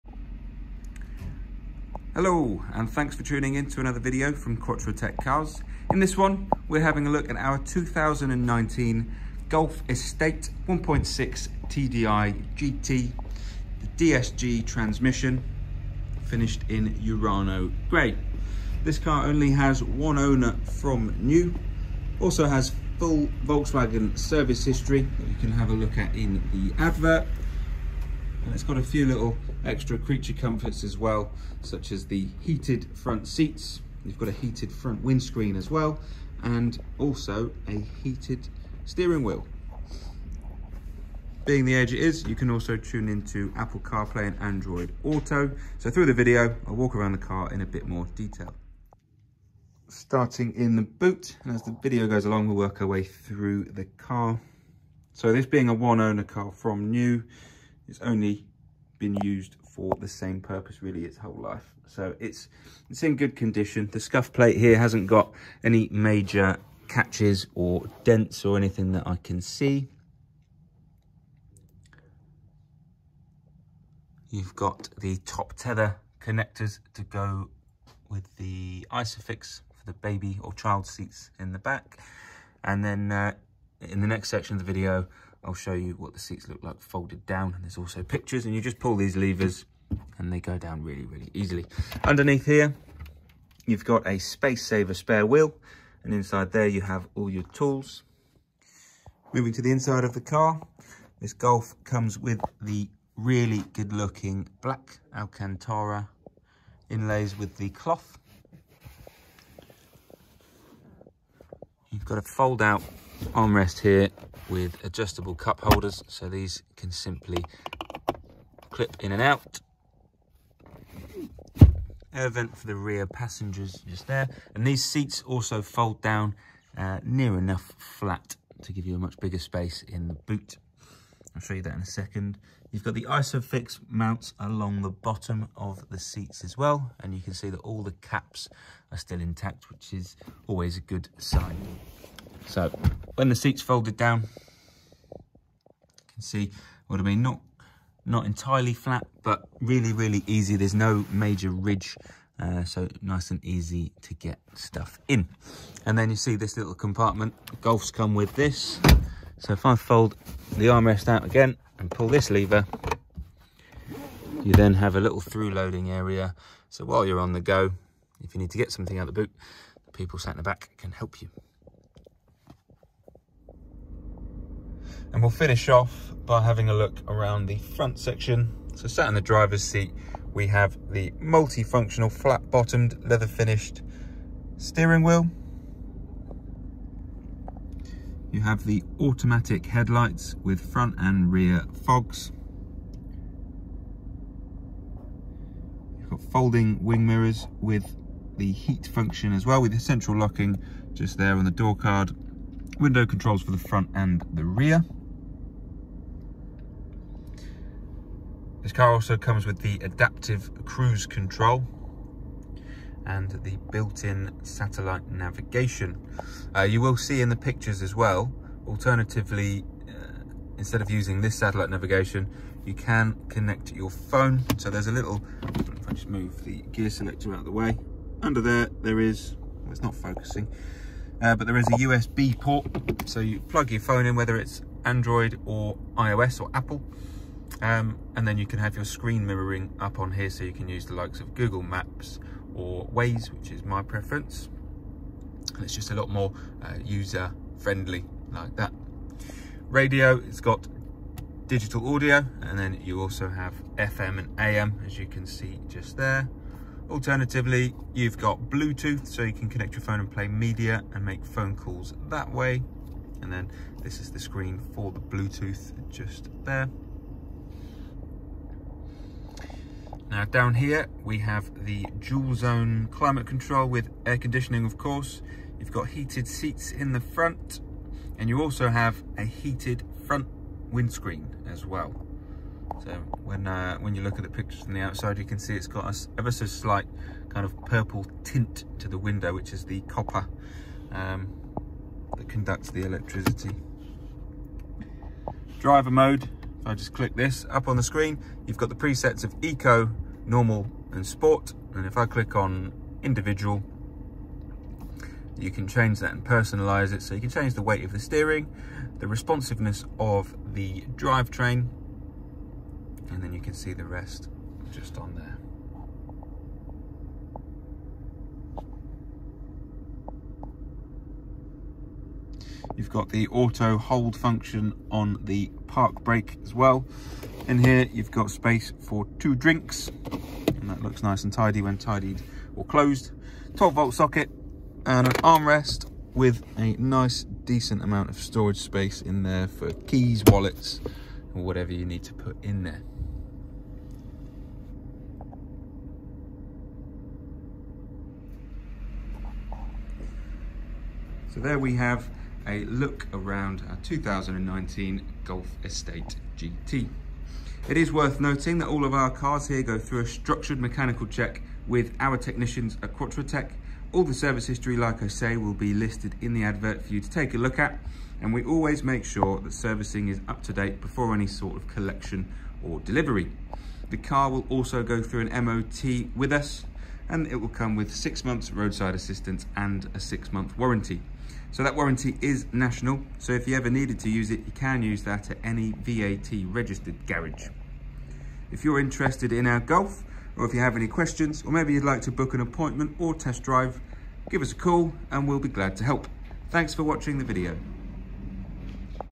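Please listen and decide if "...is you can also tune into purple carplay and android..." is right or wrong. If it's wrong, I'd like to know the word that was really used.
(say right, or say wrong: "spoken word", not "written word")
wrong: "apple", not "purple".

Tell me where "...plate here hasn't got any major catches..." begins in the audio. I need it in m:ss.
1:04.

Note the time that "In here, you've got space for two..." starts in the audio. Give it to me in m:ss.
5:27.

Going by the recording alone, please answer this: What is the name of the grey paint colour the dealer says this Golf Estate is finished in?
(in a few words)
Urano grey.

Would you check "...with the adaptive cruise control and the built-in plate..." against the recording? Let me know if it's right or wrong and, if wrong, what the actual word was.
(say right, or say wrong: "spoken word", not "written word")
wrong: "satellite", not "plate".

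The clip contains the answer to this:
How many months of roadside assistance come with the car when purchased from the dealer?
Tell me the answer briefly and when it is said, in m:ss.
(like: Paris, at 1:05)
6, at 6:17.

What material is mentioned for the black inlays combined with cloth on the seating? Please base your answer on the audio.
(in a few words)
Alcantara.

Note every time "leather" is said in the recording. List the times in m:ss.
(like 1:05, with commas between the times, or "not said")
3:03.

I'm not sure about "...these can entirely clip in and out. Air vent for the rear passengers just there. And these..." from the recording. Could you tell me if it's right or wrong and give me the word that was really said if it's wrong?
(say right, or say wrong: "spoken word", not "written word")
wrong: "simply", not "entirely".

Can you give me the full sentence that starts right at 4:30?
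Now down here, we have the dual zone climate control with air conditioning, of course.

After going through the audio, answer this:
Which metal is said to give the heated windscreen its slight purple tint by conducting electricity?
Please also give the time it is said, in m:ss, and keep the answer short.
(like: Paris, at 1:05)
Copper, at 4:49.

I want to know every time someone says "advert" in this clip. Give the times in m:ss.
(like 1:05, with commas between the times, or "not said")
0:26, 6:06.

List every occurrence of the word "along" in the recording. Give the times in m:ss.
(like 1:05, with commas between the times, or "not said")
0:52, 2:14.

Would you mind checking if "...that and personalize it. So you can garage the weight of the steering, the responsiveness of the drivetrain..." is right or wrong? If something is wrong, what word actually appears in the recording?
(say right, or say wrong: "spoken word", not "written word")
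wrong: "change", not "garage".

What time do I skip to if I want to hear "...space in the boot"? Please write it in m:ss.
2:09.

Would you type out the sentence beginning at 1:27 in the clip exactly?
And there's also pictures and you just pull these levers and they go down really, really easily.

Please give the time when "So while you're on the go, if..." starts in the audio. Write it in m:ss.
2:46.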